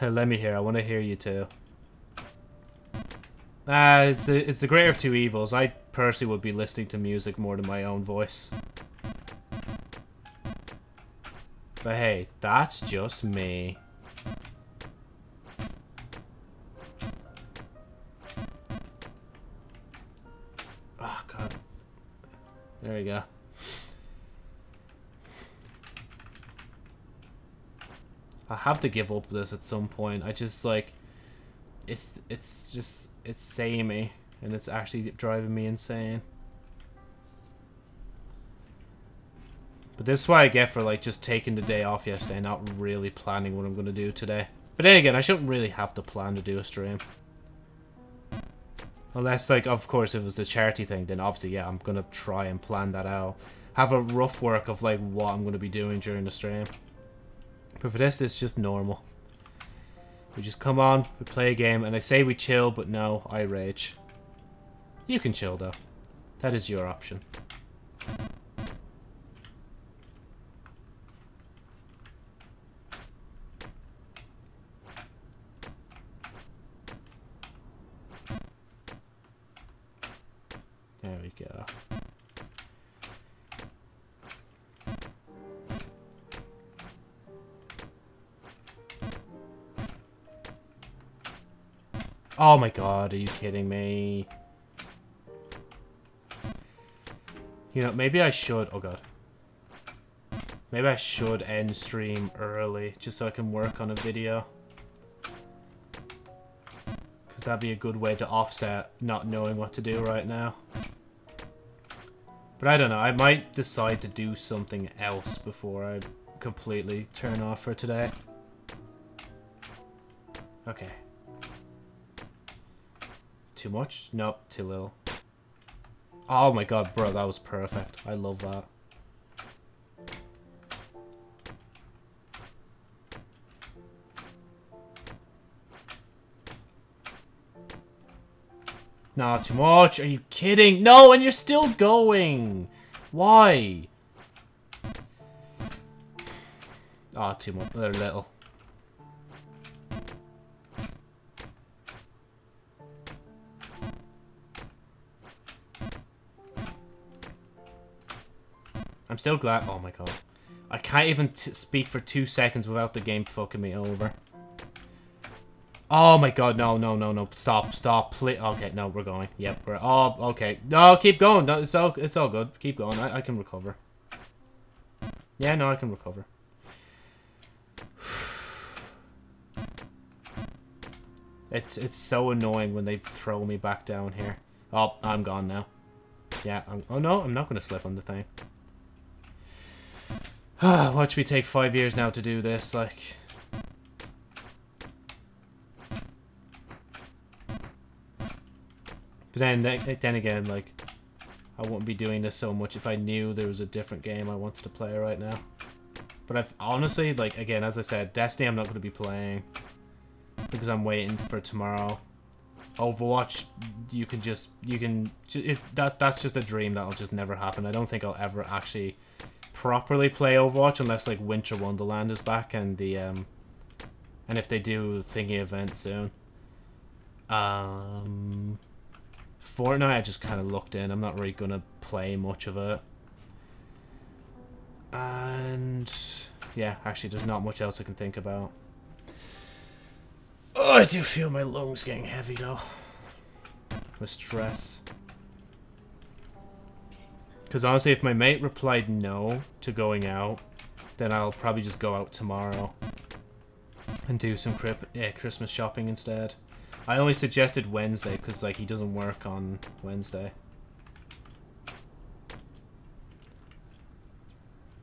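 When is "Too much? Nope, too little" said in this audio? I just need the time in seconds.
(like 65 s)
123 s.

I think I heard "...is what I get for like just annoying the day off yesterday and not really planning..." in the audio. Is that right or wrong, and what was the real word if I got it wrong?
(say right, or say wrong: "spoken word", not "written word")
wrong: "taking", not "annoying".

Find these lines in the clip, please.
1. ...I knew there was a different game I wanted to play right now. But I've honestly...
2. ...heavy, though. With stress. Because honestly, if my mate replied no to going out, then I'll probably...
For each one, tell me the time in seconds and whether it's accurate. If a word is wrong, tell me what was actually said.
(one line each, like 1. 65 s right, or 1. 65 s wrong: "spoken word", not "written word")
1. 202 s right
2. 242 s right.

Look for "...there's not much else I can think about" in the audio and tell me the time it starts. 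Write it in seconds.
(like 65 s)
237 s.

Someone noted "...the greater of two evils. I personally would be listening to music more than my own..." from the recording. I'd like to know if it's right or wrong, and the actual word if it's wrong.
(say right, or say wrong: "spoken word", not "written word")
right.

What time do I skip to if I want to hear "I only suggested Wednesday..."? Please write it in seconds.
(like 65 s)
256 s.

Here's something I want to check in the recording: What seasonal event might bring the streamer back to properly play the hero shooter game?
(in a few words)
Winter Wonderland.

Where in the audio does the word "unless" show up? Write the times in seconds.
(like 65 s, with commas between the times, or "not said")
49 s, 220 s.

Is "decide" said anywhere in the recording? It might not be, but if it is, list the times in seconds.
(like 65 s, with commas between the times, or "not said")
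113 s.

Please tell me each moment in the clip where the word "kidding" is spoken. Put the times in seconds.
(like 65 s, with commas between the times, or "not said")
93 s, 140 s.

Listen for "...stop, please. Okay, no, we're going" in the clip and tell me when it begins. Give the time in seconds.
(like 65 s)
167 s.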